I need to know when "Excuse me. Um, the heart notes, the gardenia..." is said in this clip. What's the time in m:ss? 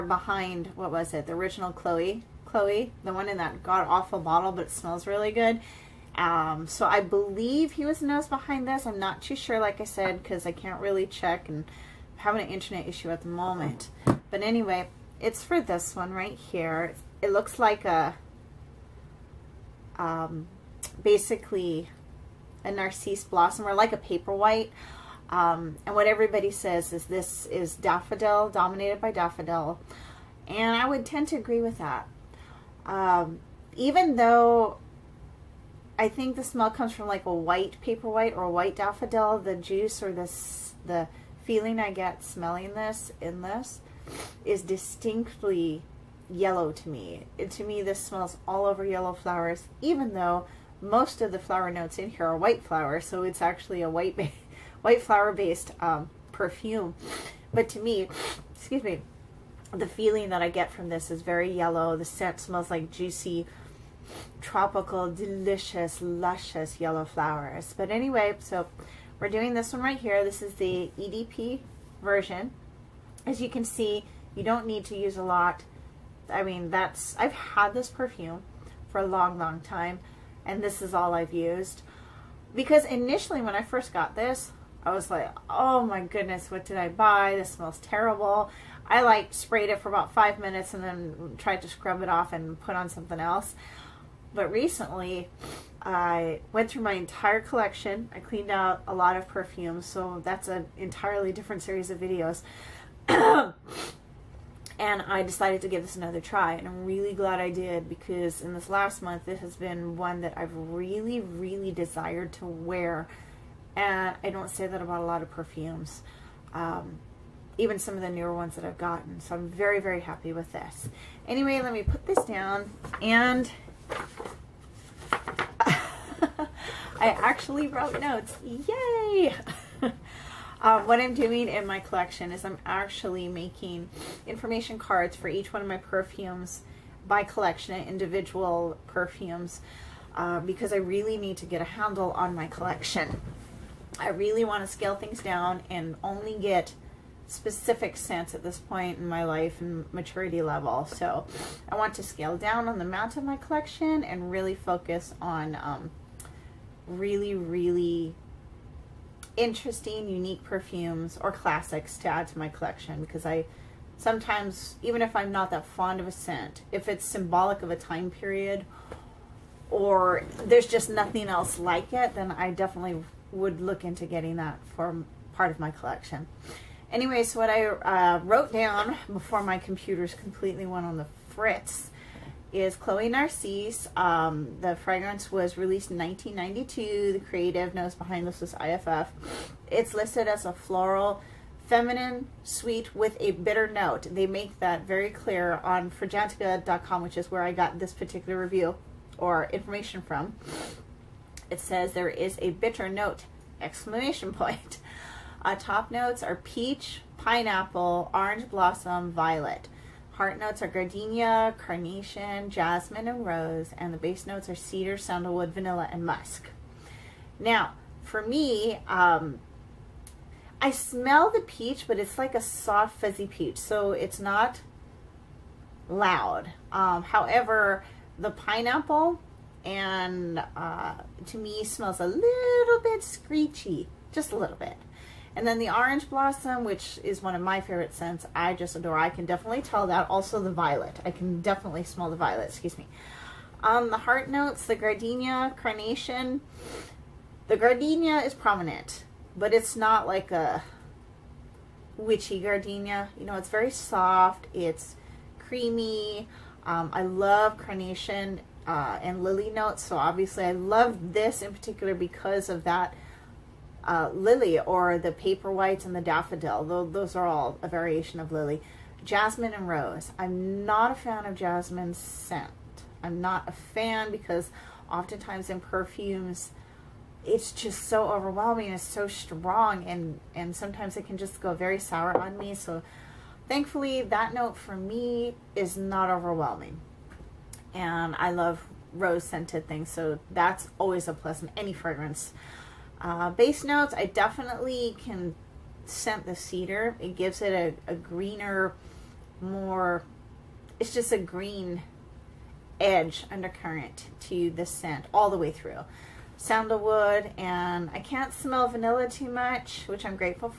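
4:02.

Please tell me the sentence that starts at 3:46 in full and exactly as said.
Um, however, the pineapple and uh, to me smells a little bit screechy, just a little bit.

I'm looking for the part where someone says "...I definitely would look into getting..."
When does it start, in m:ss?
2:52.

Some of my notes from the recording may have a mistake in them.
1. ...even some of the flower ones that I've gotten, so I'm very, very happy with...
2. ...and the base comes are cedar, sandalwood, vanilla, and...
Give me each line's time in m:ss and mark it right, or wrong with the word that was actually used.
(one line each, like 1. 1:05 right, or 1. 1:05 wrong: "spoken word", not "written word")
1. 1:57 wrong: "newer", not "flower"
2. 3:33 wrong: "notes", not "comes".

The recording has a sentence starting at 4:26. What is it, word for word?
Those are all a variation of lily.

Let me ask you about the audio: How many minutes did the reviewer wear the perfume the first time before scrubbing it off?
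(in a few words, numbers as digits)
5 minutes.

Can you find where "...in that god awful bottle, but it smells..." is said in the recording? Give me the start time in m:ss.
0:03.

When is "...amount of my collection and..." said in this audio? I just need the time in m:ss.
2:32.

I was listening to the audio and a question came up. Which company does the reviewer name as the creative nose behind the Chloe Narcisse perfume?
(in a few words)
IFF.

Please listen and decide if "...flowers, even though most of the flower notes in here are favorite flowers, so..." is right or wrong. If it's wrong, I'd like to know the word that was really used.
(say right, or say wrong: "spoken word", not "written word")
wrong: "white", not "favorite".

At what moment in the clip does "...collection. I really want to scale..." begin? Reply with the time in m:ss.
2:22.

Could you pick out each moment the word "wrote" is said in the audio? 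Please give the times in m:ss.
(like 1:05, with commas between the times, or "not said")
2:07, 2:58.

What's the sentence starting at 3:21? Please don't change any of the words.
It says there is a bitter note, exclamation point.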